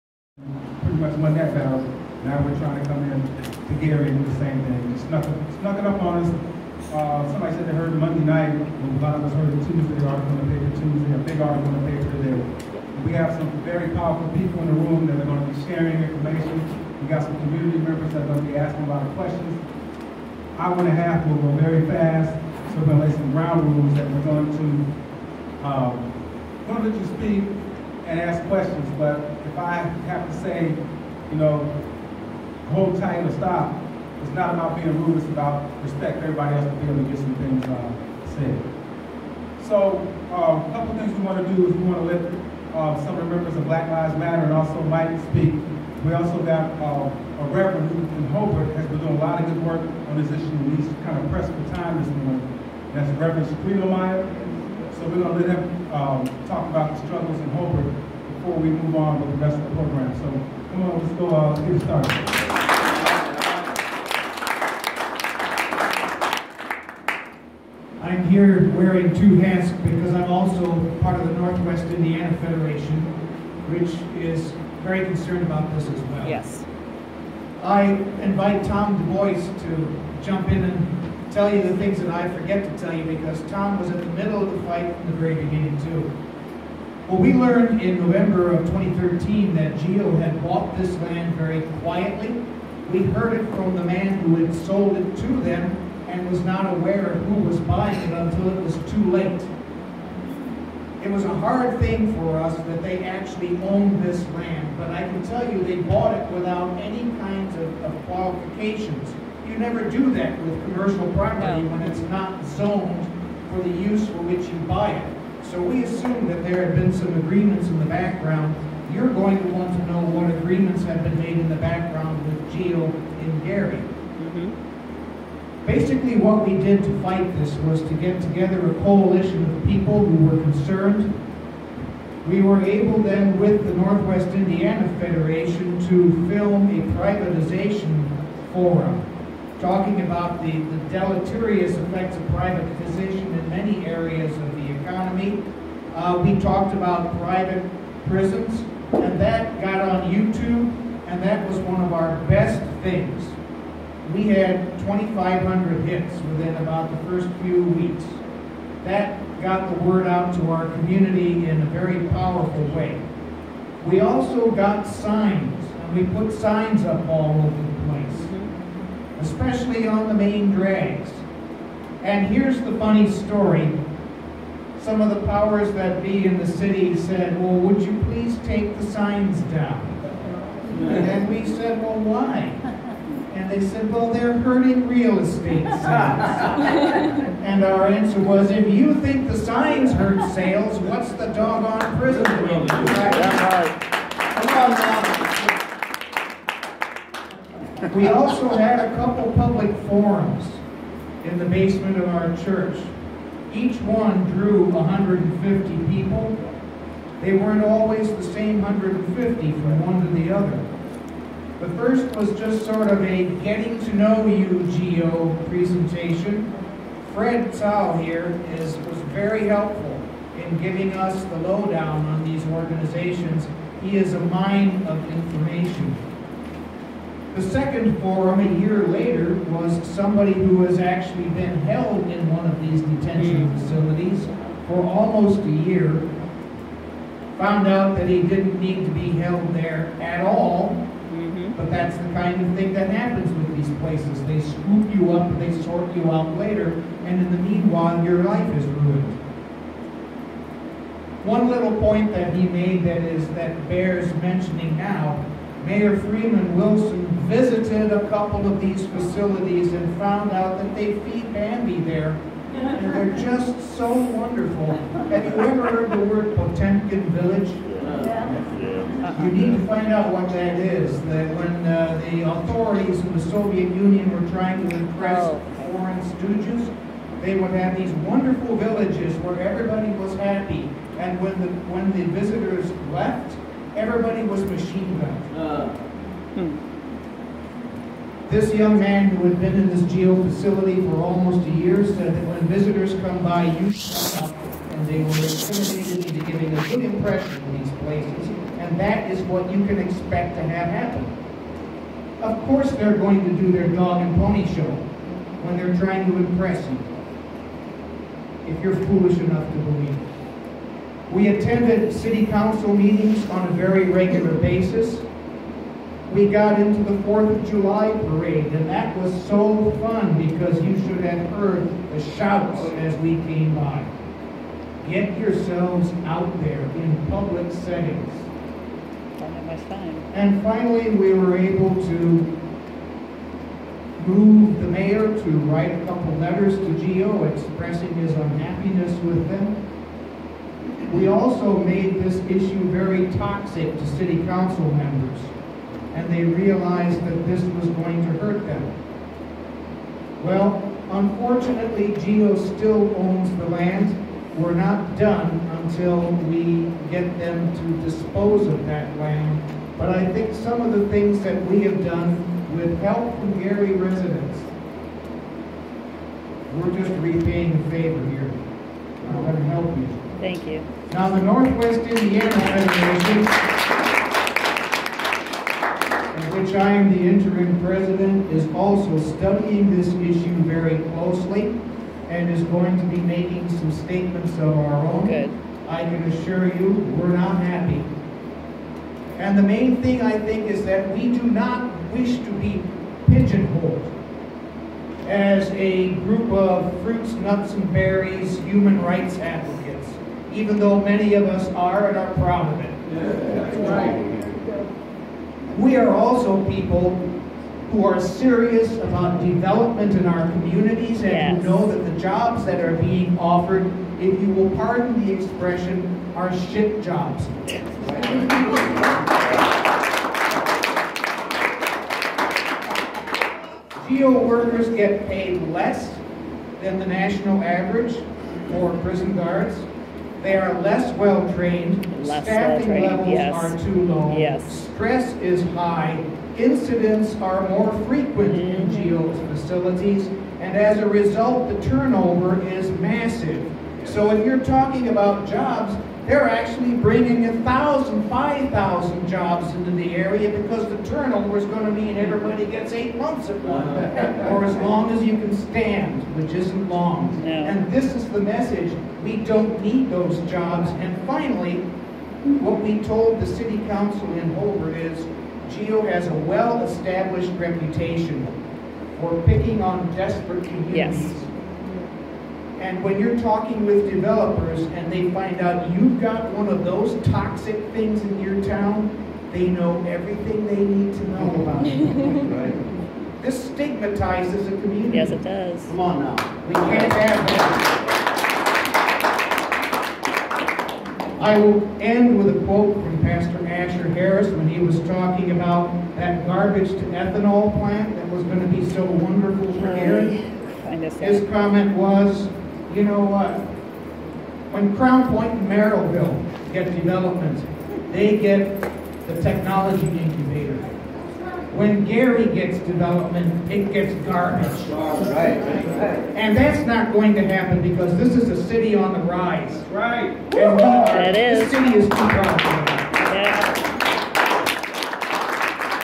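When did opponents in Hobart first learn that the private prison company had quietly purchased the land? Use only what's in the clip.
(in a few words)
November 2013.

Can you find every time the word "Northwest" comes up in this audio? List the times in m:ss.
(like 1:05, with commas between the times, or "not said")
1:11, 2:13, 6:11.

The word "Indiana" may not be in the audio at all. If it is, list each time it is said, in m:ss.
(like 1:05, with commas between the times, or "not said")
1:11, 2:14, 6:11.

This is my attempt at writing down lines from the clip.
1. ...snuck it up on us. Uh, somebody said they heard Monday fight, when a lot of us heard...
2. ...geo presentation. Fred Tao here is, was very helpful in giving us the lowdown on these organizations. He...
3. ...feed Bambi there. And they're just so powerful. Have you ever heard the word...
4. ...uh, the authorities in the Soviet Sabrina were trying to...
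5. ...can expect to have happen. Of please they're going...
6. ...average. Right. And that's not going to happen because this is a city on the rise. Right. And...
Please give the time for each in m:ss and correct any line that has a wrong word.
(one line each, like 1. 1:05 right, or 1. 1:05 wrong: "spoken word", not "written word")
1. 0:05 wrong: "night", not "fight"
2. 3:34 right
3. 4:21 wrong: "wonderful", not "powerful"
4. 4:31 wrong: "Union", not "Sabrina"
5. 4:59 wrong: "course", not "please"
6. 8:34 wrong: "garbage", not "average".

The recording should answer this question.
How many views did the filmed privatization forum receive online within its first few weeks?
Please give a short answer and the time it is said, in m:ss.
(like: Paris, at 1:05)
2,500, at 2:34.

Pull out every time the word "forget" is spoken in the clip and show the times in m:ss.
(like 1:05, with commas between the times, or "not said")
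1:22.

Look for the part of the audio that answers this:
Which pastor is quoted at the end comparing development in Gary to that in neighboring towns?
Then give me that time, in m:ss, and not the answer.
8:13.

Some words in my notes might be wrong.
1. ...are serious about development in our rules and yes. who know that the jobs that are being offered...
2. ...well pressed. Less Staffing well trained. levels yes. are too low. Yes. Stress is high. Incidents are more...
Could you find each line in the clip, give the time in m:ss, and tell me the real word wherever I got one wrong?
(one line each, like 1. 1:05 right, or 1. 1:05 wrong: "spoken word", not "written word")
1. 6:47 wrong: "communities", not "rules"
2. 7:10 wrong: "trained", not "pressed".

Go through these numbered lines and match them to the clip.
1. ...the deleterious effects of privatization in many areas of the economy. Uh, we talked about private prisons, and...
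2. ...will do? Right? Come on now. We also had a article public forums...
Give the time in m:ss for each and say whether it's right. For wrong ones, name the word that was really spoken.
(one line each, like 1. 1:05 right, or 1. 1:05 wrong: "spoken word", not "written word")
1. 2:20 right
2. 3:12 wrong: "couple", not "article".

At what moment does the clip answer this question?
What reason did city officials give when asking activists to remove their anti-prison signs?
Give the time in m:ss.
3:04.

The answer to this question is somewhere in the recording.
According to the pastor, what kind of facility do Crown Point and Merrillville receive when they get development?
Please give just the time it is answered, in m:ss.
8:29.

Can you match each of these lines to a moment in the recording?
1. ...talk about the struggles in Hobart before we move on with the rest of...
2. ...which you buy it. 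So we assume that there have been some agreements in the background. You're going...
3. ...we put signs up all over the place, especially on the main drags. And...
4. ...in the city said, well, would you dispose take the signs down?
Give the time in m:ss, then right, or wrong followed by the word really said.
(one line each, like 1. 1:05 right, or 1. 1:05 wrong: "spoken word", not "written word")
1. 0:56 right
2. 1:54 right
3. 2:45 right
4. 2:56 wrong: "please", not "dispose".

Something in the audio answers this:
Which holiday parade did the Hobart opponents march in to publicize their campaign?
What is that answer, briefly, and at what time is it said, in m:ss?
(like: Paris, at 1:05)
4th of July, at 5:17.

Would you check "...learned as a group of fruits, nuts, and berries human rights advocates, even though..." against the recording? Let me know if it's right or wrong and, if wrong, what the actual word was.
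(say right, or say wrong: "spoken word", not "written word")
wrong: "pigeonholed", not "learned".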